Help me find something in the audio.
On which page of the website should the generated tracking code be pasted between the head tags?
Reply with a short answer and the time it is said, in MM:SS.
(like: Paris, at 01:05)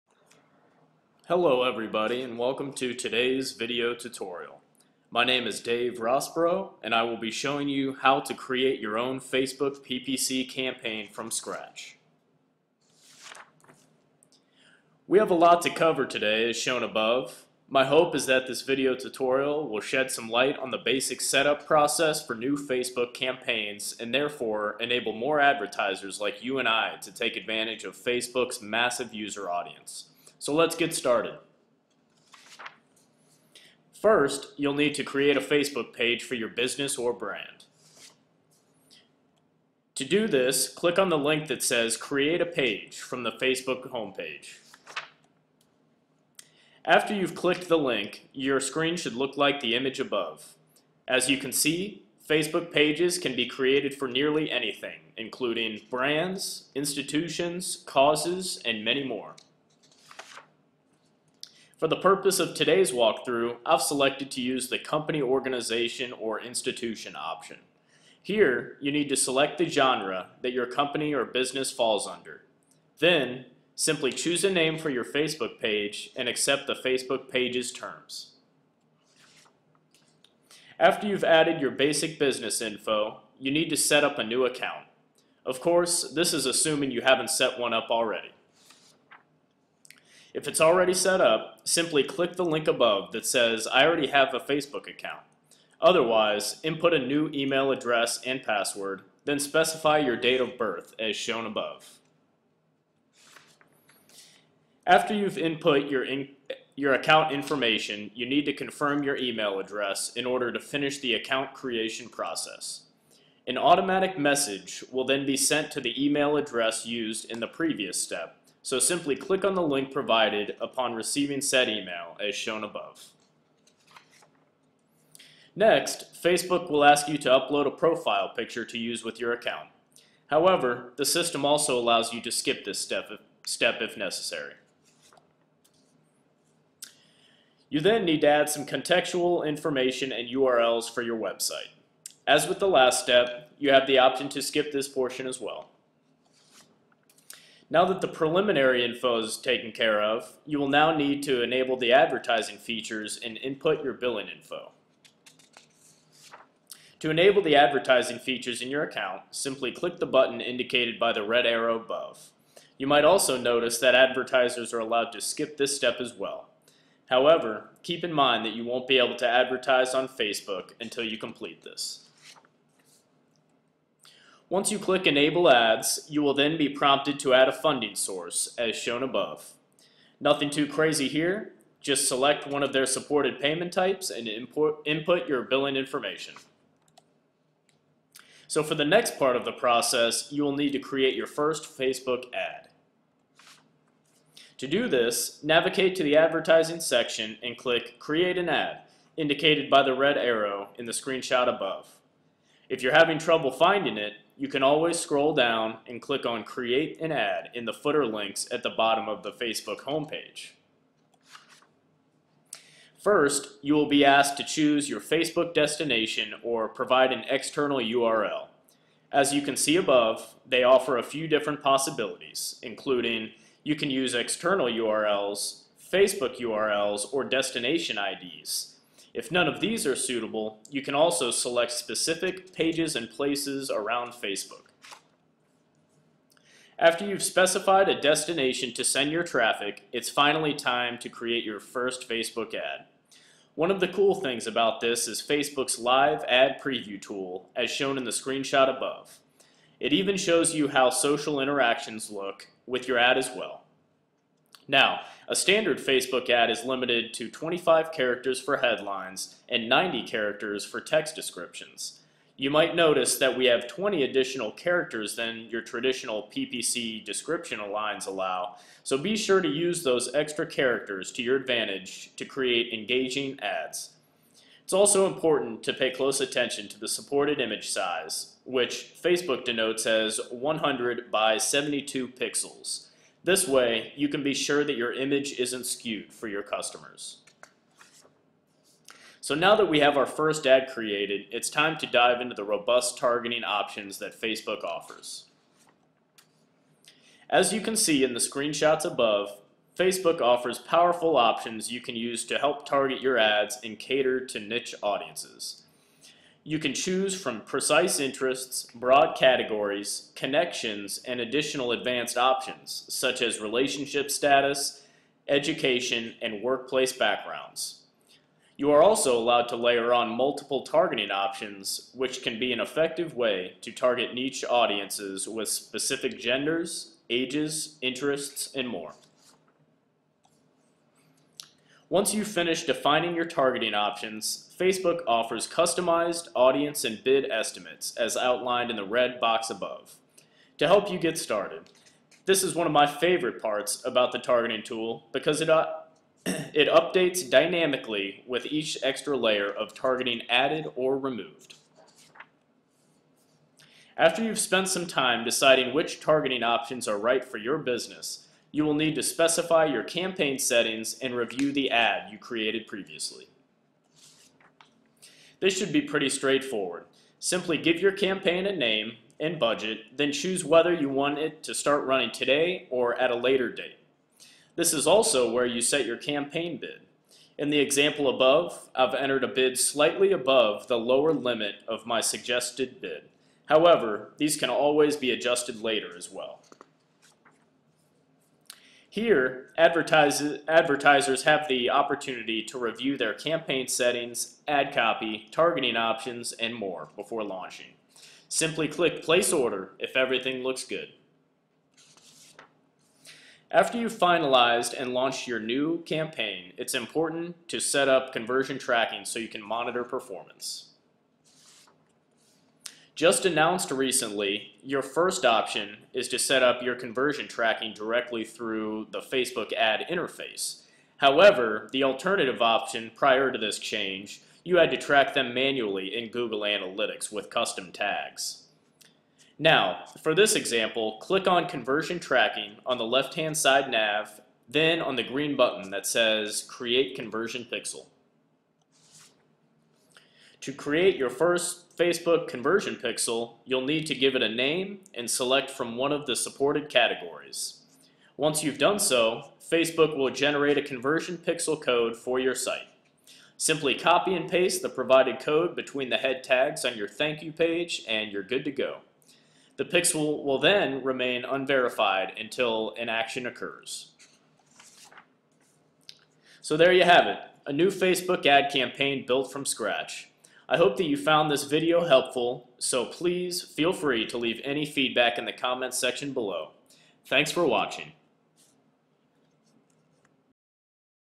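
thank you page, at 07:36.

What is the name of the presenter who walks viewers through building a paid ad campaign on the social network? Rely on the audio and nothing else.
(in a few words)
Dave Rosborough.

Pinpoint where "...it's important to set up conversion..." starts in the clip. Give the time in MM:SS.
06:46.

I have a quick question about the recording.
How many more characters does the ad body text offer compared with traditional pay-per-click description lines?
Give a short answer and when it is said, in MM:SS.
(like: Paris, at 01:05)
20, at 04:23.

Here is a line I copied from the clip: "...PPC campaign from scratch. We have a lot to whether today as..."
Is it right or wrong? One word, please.
wrong.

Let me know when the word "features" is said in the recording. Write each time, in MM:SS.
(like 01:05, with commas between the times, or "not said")
02:32, 02:38.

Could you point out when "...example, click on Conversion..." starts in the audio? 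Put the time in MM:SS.
07:10.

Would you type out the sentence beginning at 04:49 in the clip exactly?
So now that we have our first ad created, it's time to dive into the robust targeting options that Facebook offers.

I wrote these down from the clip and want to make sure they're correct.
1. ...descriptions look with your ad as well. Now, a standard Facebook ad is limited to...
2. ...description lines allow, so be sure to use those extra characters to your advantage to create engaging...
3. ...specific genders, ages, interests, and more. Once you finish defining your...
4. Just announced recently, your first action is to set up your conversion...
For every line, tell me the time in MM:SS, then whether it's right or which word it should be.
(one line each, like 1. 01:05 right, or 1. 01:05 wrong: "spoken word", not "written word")
1. 04:11 wrong: "interactions", not "descriptions"
2. 04:27 right
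3. 05:25 right
4. 06:53 wrong: "option", not "action".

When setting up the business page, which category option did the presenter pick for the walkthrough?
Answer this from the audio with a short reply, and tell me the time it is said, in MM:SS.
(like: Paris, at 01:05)
company organization or institution, at 01:04.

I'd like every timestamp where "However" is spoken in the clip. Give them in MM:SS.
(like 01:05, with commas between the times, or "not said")
02:10, 02:47, 06:23, 07:00.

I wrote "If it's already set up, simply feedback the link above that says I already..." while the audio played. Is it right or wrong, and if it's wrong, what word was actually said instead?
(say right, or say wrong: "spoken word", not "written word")
wrong: "click", not "feedback".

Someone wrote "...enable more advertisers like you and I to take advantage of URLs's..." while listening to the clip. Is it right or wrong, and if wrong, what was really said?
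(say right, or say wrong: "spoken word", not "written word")
wrong: "Facebook", not "URLs".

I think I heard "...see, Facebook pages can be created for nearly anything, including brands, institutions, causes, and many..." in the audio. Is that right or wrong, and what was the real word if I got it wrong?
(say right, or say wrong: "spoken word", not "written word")
right.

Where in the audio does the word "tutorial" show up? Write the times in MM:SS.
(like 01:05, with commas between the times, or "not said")
00:03, 00:18.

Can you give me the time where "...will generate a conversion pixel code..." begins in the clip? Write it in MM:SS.
07:29.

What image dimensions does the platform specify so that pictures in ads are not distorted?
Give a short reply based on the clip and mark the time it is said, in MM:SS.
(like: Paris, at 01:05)
100 by 72 pixels, at 04:40.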